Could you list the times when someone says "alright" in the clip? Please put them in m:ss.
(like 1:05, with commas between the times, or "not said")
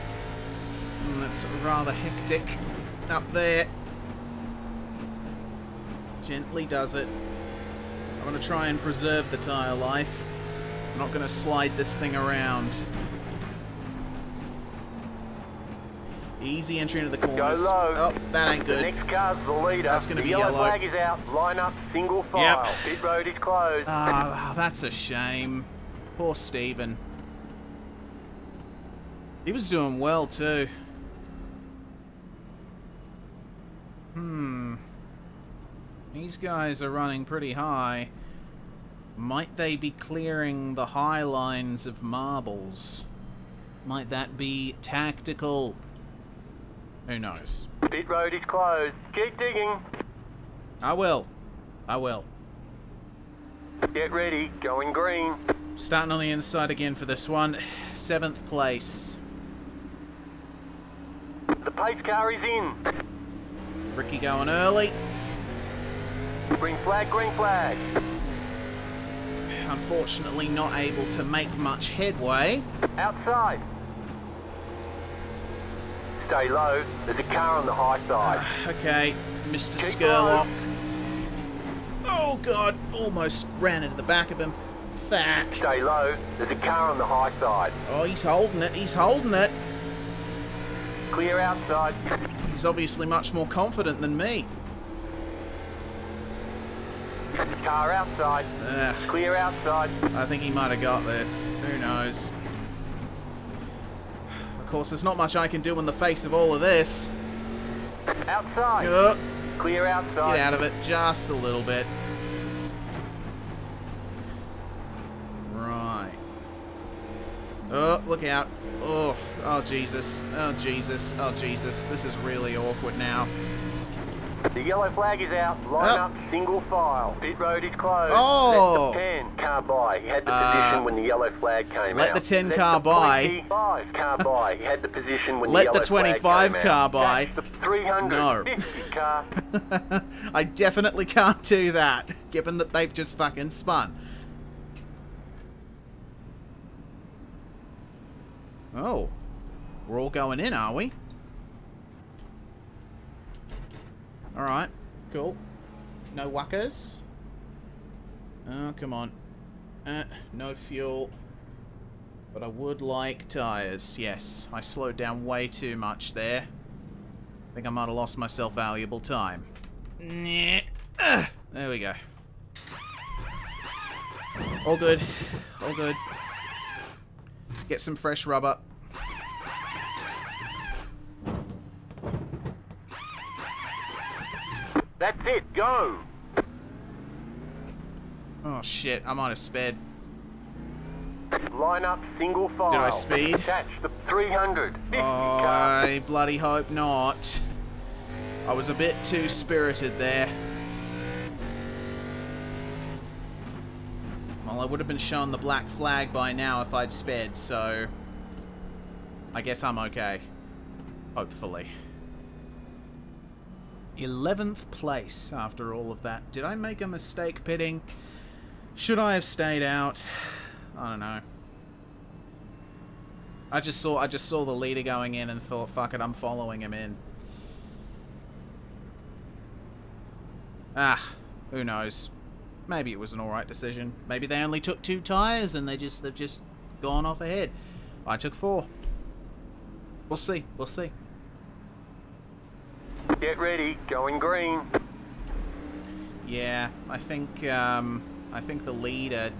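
2:34, 3:53.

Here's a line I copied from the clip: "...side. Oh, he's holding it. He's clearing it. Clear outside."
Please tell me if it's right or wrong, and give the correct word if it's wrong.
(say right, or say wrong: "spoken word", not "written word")
wrong: "holding", not "clearing".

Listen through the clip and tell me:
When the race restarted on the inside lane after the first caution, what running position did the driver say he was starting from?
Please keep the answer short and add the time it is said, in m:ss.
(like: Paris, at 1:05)
7th place, at 0:57.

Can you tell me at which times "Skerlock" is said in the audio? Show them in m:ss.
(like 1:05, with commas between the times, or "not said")
1:20.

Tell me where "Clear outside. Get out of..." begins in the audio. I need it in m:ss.
1:49.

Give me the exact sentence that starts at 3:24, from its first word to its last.
Well, I would have been shown the black flag by now if I'd sped, so...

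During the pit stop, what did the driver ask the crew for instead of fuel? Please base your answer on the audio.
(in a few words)
Tyres.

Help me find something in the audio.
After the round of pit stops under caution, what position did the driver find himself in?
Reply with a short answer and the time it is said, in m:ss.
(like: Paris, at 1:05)
11th place, at 3:34.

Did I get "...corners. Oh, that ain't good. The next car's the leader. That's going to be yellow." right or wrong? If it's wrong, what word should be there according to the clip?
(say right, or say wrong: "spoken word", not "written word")
right.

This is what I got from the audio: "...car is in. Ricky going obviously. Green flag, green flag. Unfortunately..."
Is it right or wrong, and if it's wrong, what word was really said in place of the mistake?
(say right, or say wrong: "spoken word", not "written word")
wrong: "early", not "obviously".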